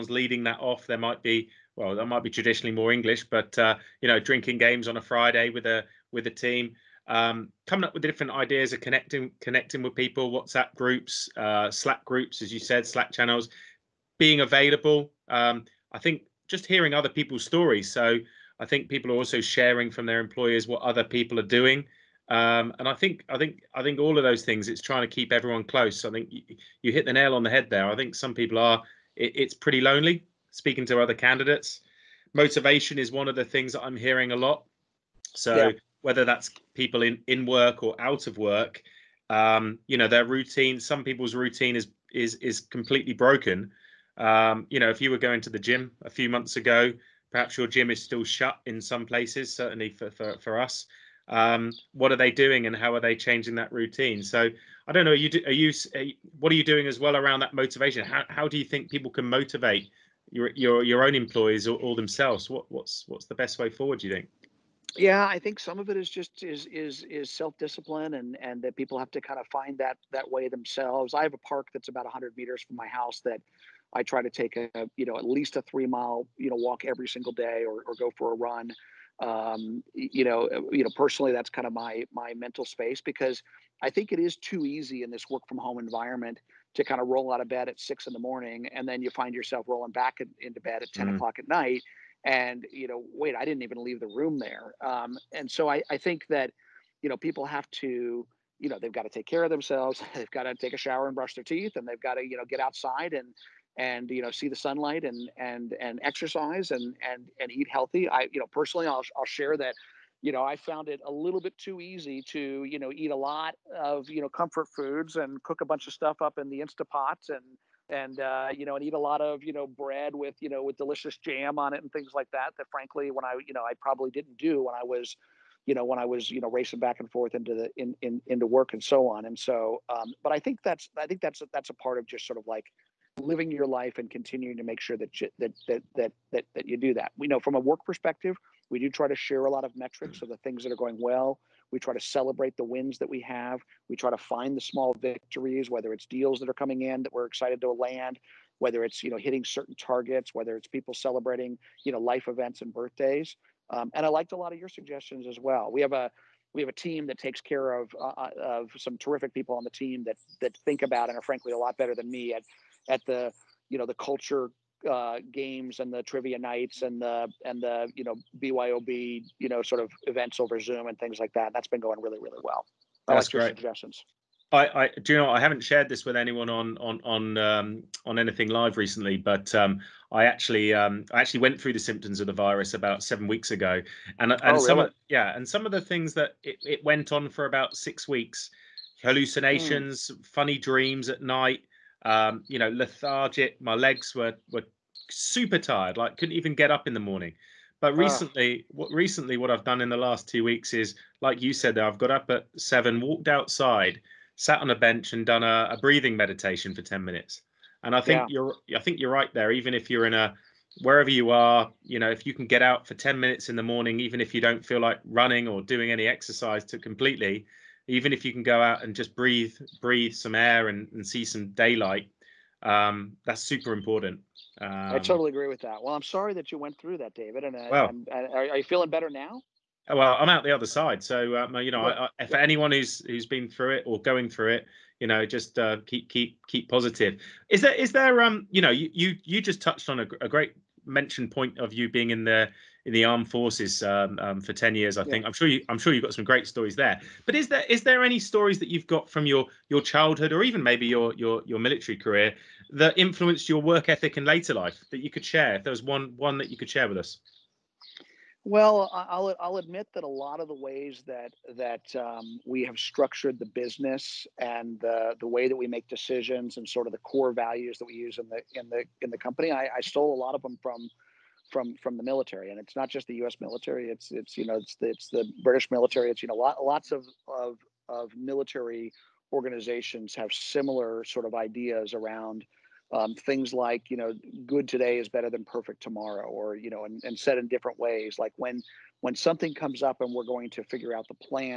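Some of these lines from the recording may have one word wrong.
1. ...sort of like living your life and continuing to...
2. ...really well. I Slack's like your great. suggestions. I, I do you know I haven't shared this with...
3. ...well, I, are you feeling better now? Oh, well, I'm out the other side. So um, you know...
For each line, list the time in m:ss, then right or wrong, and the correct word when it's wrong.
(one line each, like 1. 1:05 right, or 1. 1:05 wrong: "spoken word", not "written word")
1. 2:12 right
2. 2:52 wrong: "That", not "Slack"
3. 3:47 right.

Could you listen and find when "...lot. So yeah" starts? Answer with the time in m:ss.
0:34.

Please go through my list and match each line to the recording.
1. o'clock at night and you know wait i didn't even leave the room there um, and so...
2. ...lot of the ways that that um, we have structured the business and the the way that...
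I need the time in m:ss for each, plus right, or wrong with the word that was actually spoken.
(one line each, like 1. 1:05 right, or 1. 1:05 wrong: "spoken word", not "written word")
1. 1:31 right
2. 4:20 right.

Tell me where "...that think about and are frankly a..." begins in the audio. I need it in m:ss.
2:40.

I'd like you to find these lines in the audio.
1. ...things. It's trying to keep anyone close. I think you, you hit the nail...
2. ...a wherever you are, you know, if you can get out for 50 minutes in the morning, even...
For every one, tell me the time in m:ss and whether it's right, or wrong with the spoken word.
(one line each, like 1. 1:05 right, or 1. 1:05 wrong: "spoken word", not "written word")
1. 0:24 wrong: "everyone", not "anyone"
2. 3:30 wrong: "10", not "50".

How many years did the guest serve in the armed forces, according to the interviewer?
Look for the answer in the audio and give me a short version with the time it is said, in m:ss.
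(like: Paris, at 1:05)
10, at 4:04.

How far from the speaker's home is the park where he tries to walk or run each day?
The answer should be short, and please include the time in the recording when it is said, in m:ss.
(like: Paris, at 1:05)
100 meters, at 1:12.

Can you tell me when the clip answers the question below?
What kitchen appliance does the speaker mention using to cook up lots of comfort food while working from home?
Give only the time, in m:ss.
1:56.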